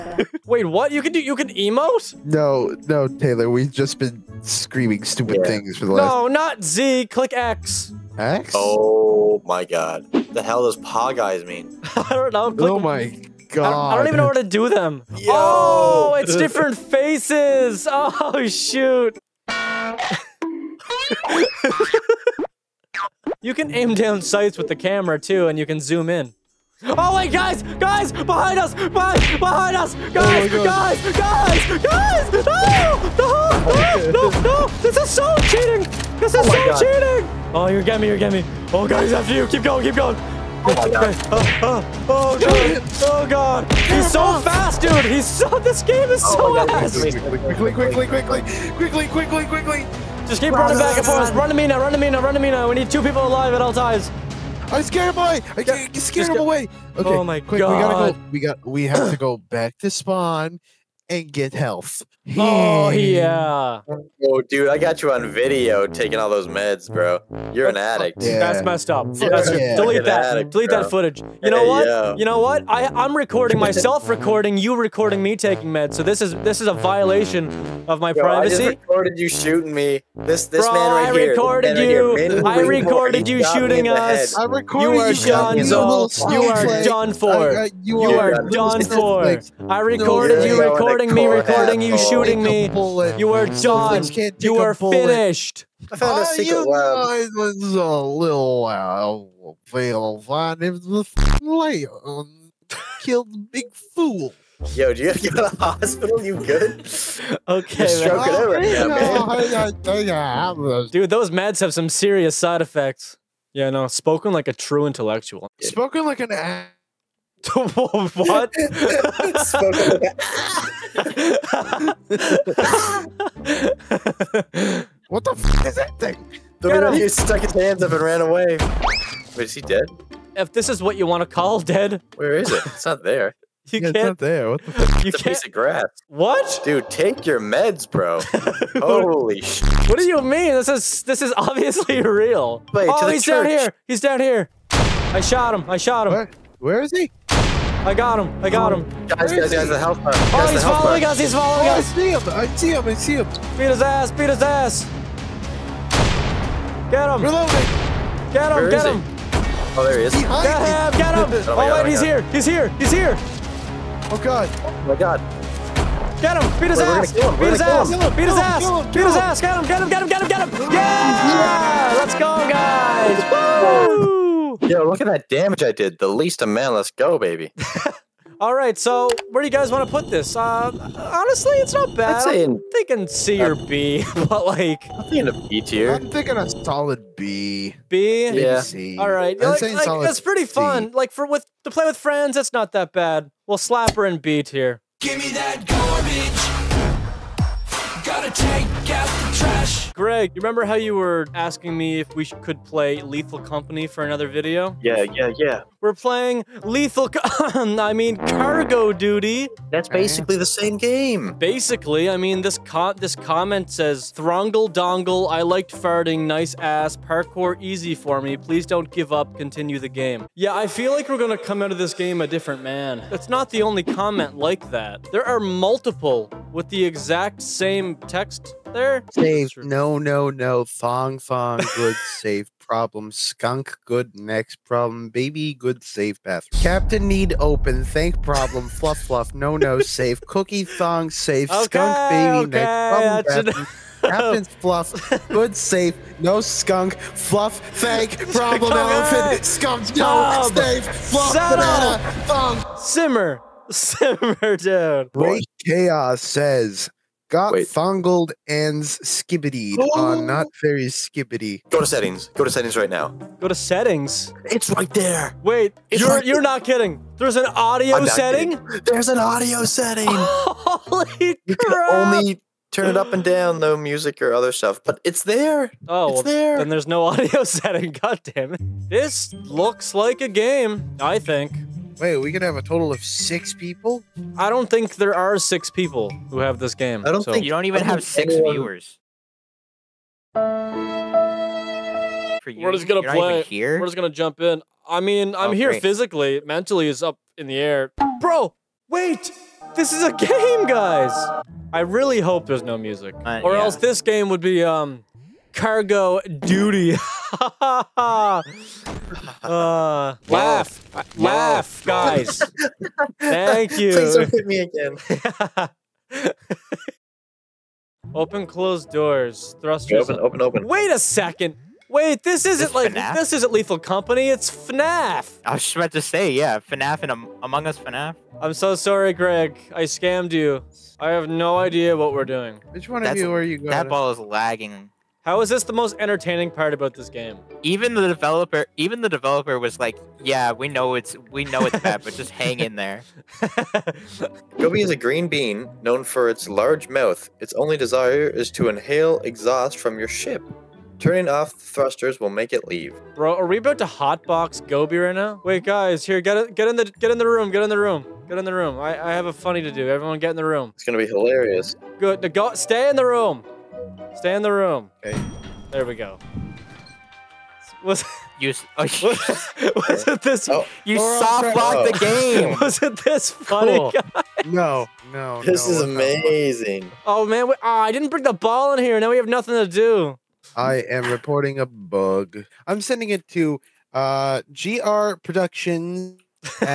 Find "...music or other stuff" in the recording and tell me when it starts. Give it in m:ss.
4:33.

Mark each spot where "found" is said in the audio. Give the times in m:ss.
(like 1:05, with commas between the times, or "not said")
1:35.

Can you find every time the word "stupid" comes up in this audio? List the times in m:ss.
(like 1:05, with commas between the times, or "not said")
0:05.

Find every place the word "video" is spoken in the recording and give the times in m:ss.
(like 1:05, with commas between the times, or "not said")
1:05, 3:24.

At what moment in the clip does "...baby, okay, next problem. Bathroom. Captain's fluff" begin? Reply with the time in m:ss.
4:02.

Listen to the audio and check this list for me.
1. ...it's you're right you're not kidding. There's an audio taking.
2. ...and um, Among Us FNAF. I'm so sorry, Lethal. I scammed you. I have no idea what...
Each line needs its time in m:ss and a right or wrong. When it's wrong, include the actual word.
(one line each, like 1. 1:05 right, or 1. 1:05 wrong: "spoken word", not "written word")
1. 4:25 wrong: "setting", not "taking"
2. 5:27 wrong: "Greg", not "Lethal".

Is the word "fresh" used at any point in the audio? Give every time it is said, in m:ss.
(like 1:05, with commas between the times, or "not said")
not said.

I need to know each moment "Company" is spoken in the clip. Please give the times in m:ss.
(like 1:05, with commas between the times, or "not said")
3:23, 5:23.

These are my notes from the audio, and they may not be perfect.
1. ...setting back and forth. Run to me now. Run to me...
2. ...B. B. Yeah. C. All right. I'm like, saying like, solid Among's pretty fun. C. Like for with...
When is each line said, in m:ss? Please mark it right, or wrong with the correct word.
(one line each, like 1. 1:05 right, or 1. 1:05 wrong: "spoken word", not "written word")
1. 0:50 wrong: "running", not "setting"
2. 3:07 wrong: "That", not "Among".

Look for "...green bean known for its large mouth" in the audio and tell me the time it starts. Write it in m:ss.
5:44.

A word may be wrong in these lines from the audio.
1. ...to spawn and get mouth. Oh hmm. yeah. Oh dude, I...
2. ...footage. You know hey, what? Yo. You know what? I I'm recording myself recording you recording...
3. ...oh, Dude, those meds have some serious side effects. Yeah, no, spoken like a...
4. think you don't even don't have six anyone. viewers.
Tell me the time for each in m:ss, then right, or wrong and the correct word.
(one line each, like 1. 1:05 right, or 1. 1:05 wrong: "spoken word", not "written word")
1. 0:59 wrong: "health", not "mouth"
2. 1:10 right
3. 1:49 right
4. 4:47 right.